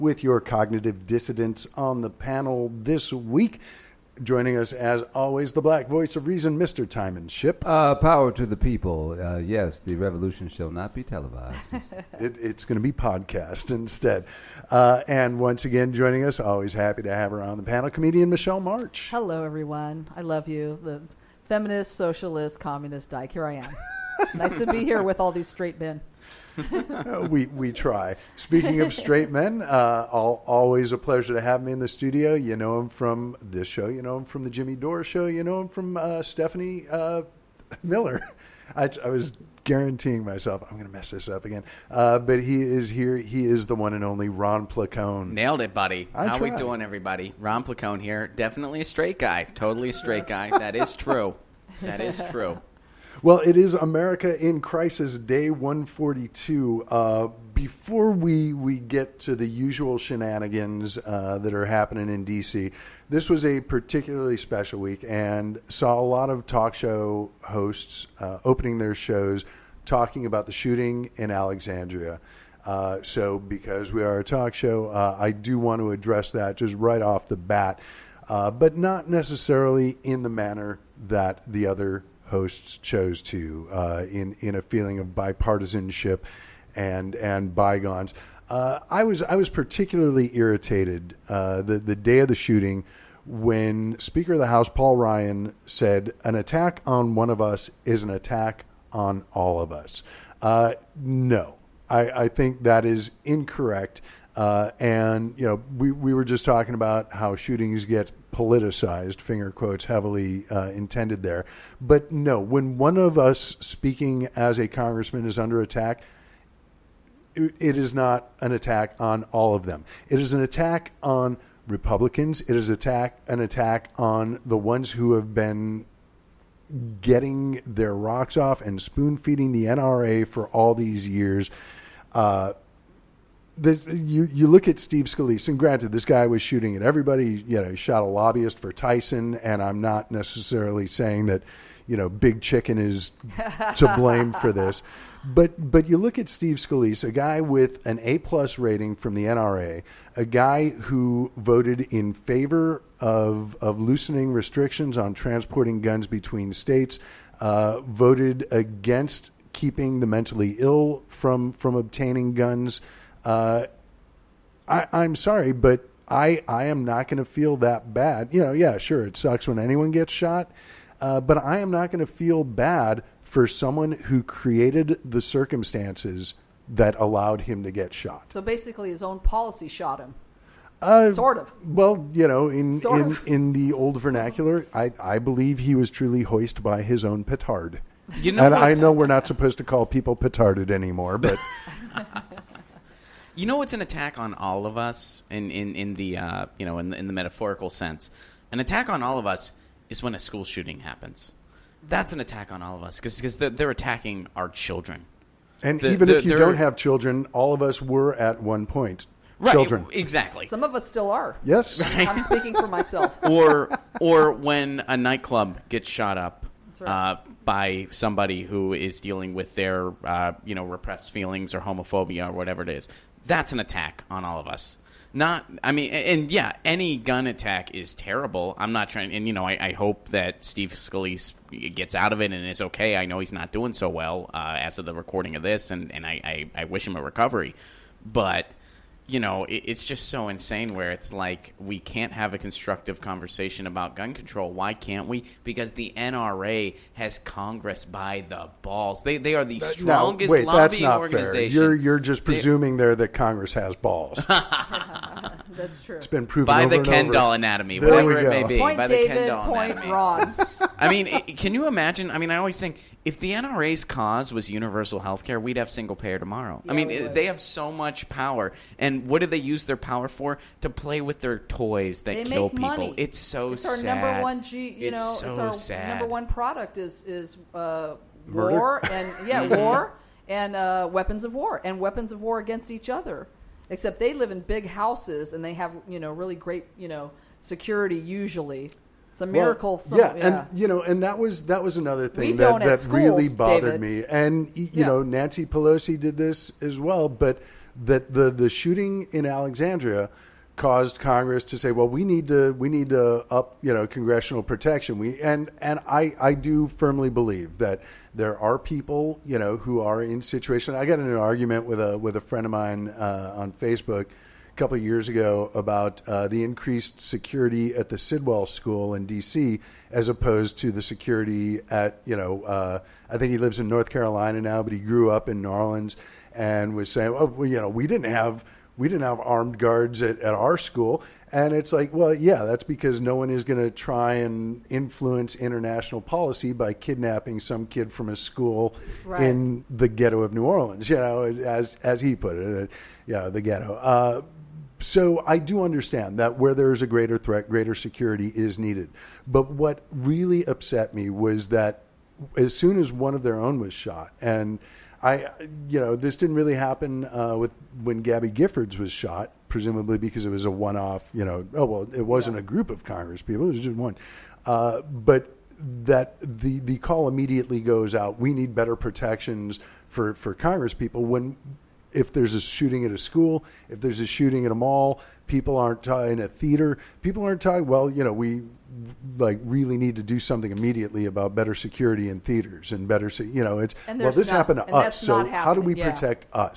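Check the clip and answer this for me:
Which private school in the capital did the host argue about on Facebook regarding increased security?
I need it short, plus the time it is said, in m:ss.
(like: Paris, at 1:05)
Sidwell School, at 5:17.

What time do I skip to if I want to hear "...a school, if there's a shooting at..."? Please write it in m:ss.
6:12.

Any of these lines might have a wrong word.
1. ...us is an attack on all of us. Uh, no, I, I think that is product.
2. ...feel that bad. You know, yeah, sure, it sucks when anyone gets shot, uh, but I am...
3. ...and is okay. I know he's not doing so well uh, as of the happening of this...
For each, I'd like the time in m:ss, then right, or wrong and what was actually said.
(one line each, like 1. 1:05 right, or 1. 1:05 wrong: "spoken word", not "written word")
1. 1:37 wrong: "incorrect", not "product"
2. 2:47 right
3. 3:52 wrong: "recording", not "happening".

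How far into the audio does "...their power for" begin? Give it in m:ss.
4:29.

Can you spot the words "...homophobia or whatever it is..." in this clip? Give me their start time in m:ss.
3:41.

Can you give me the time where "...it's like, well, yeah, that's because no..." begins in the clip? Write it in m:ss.
5:31.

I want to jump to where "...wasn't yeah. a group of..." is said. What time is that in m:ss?
6:02.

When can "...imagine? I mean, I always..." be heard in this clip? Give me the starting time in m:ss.
4:21.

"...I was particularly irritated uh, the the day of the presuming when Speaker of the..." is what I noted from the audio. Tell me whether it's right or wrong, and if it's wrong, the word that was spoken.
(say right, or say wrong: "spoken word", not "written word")
wrong: "shooting", not "presuming".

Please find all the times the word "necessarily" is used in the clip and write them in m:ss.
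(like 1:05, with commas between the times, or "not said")
1:19, 2:20.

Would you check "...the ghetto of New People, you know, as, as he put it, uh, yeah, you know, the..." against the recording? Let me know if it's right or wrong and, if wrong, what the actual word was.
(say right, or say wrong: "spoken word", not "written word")
wrong: "Orleans", not "People".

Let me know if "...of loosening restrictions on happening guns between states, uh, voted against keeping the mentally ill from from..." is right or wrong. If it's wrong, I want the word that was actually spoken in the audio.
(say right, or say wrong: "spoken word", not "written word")
wrong: "transporting", not "happening".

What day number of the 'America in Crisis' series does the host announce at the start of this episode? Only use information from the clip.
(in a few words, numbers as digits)
142.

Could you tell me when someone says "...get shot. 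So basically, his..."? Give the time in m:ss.
2:57.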